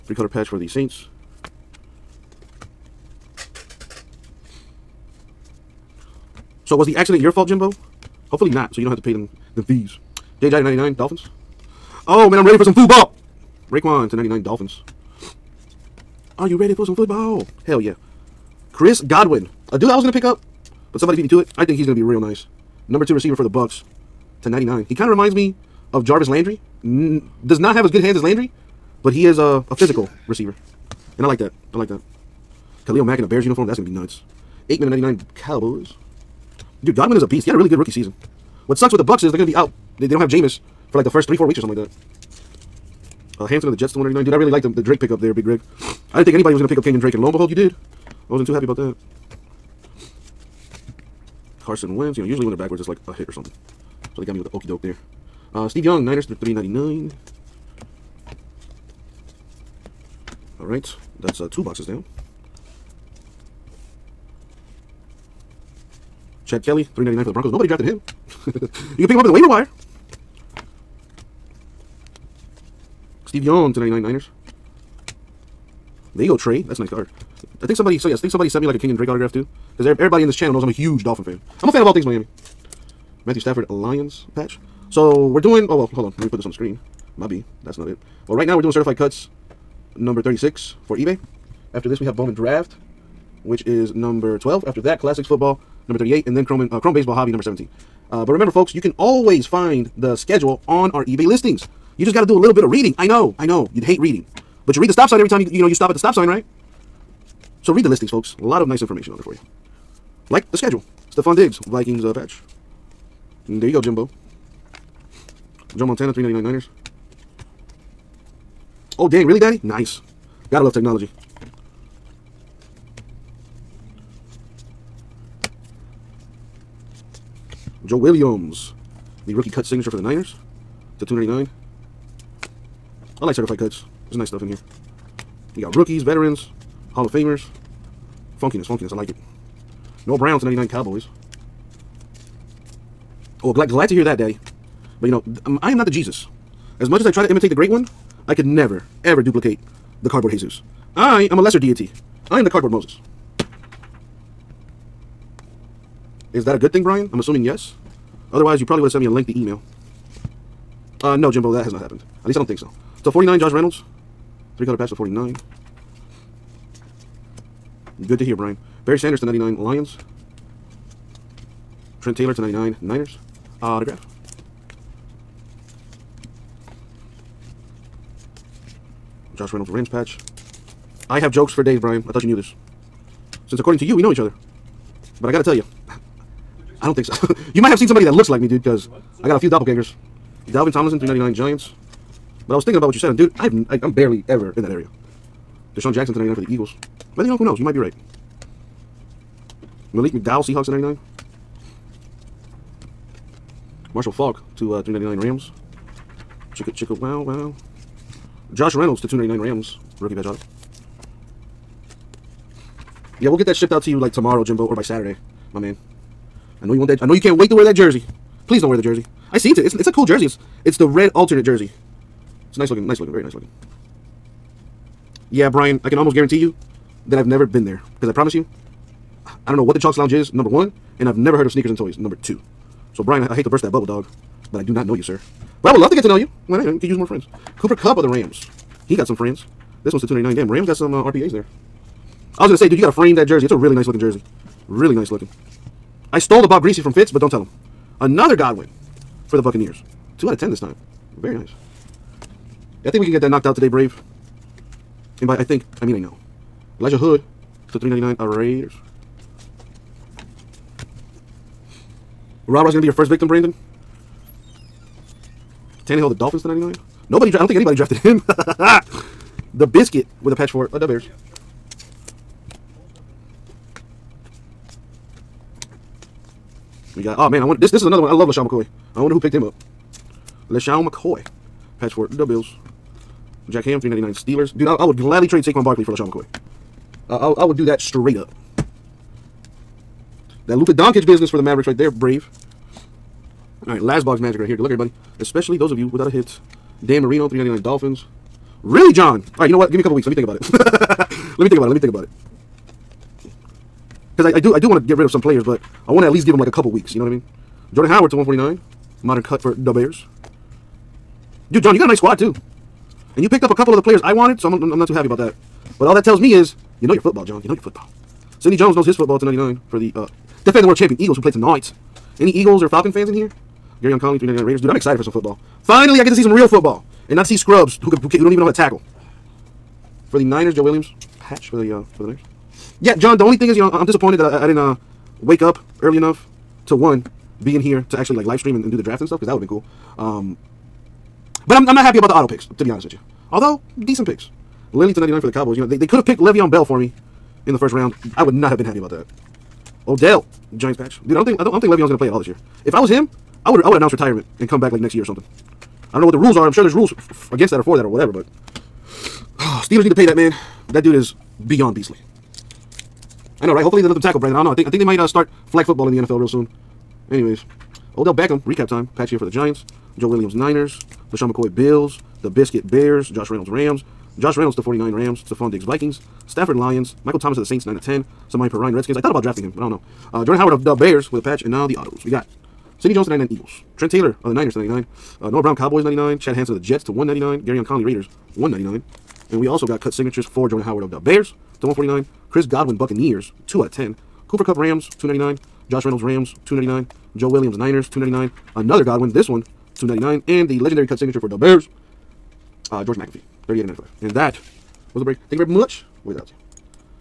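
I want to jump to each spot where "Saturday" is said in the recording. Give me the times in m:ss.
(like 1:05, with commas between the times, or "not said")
3:34.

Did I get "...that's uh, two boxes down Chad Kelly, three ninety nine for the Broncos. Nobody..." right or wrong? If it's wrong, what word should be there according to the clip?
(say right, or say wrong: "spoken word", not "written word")
right.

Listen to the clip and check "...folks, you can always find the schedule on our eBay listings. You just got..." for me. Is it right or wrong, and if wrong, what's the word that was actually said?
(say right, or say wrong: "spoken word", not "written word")
right.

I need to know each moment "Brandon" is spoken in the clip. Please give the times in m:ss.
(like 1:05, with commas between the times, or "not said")
4:23, 6:04.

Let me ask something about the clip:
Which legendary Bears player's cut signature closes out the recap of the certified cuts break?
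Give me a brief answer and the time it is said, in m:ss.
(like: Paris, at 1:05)
George McAfee, at 6:42.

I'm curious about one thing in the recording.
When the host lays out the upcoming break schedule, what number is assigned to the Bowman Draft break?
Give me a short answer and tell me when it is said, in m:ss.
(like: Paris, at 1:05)
12, at 1:33.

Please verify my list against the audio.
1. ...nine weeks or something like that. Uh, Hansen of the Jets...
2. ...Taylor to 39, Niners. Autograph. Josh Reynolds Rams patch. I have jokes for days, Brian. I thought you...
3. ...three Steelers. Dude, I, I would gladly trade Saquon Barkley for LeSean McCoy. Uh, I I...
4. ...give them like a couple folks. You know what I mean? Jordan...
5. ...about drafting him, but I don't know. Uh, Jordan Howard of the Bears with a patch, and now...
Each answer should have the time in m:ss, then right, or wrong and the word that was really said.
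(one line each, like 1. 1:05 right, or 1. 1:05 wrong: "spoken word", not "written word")
1. 0:41 wrong: "four", not "nine"
2. 2:52 wrong: "99", not "39"
3. 4:44 wrong: "nine", not "three"
4. 5:06 wrong: "weeks", not "folks"
5. 6:19 right.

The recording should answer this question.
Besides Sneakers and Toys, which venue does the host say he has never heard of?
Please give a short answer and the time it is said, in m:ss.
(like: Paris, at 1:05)
Chalks Lounge, at 3:49.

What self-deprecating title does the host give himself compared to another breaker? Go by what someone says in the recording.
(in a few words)
cardboard Moses.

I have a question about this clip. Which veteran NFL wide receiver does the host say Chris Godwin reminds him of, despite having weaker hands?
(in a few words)
Jarvis Landry.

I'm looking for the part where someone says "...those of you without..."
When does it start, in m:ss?
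4:55.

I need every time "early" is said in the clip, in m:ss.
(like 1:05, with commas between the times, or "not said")
5:35.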